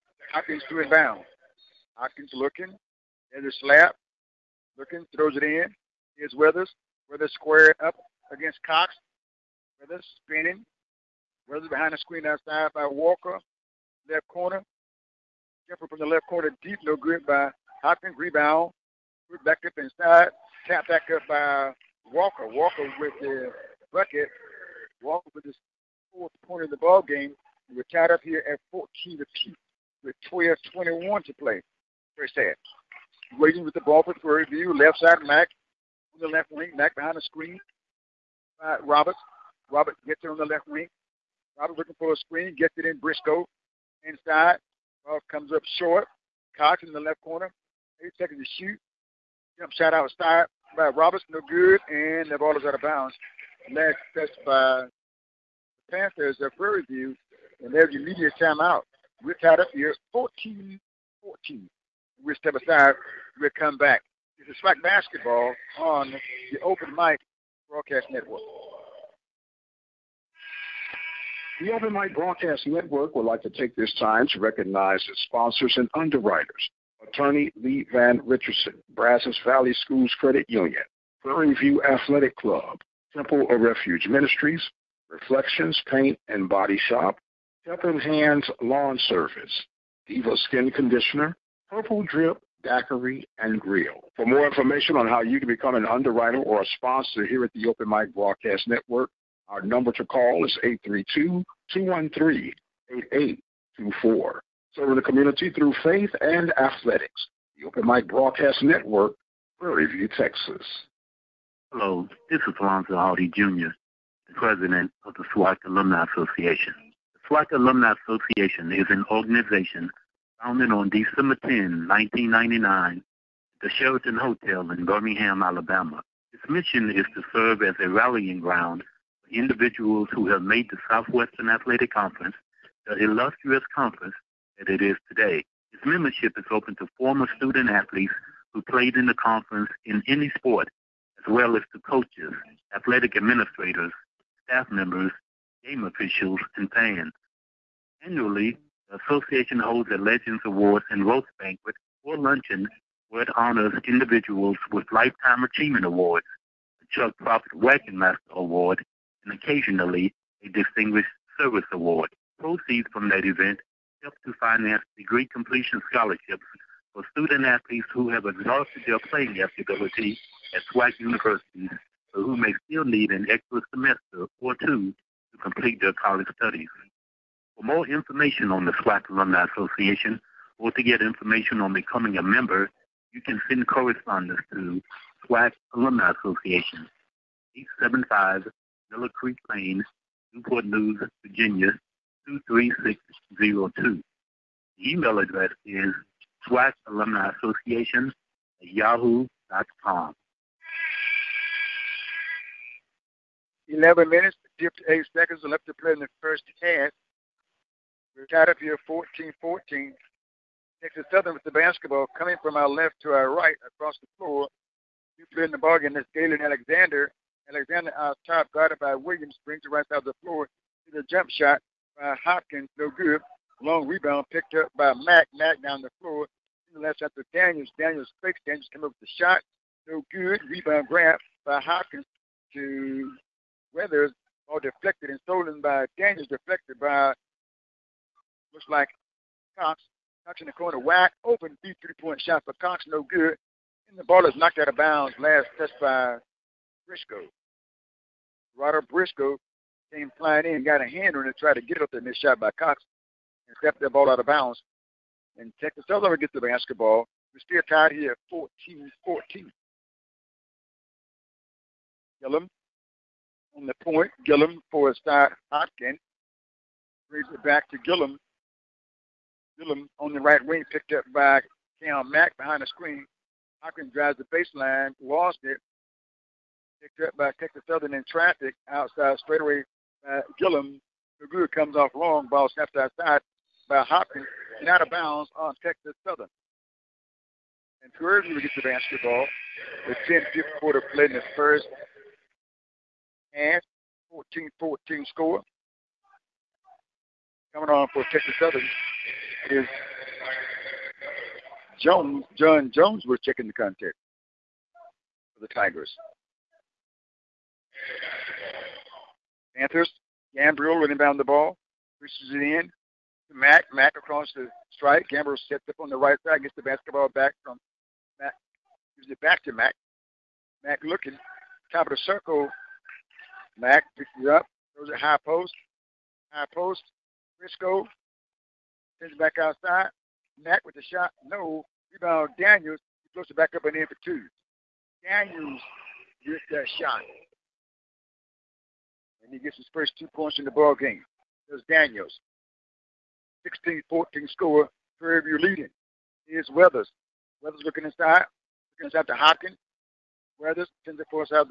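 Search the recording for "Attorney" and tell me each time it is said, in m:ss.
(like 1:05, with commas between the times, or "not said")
1:17.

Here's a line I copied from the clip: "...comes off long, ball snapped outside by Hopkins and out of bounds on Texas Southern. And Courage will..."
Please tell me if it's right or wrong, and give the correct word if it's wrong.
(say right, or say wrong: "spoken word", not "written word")
right.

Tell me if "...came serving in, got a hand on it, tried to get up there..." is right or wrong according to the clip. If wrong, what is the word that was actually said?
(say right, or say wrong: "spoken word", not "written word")
wrong: "flying", not "serving".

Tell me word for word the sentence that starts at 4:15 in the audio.
And Texas Southern ever gets the basketball.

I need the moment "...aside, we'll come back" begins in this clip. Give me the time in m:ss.
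1:02.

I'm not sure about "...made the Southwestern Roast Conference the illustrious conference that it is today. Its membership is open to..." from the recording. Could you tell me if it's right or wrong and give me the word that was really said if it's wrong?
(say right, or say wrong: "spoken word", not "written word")
wrong: "Athletic", not "Roast".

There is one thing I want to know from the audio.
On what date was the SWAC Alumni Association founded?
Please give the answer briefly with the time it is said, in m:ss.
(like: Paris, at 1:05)
December 10, 1999, at 2:00.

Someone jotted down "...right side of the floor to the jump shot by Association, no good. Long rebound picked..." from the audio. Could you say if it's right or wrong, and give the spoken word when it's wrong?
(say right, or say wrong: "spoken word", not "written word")
wrong: "Hopkins", not "Association".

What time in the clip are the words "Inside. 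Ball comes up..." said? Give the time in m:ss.
0:44.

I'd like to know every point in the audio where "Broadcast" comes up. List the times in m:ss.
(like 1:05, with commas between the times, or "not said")
1:07, 1:12, 1:38, 1:48.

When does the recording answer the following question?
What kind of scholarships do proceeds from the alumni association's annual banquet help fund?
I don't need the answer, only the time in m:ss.
2:44.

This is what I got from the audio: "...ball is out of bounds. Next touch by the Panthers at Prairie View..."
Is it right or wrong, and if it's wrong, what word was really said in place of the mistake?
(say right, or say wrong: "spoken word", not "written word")
right.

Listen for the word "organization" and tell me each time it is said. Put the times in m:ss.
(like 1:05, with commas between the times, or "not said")
1:59.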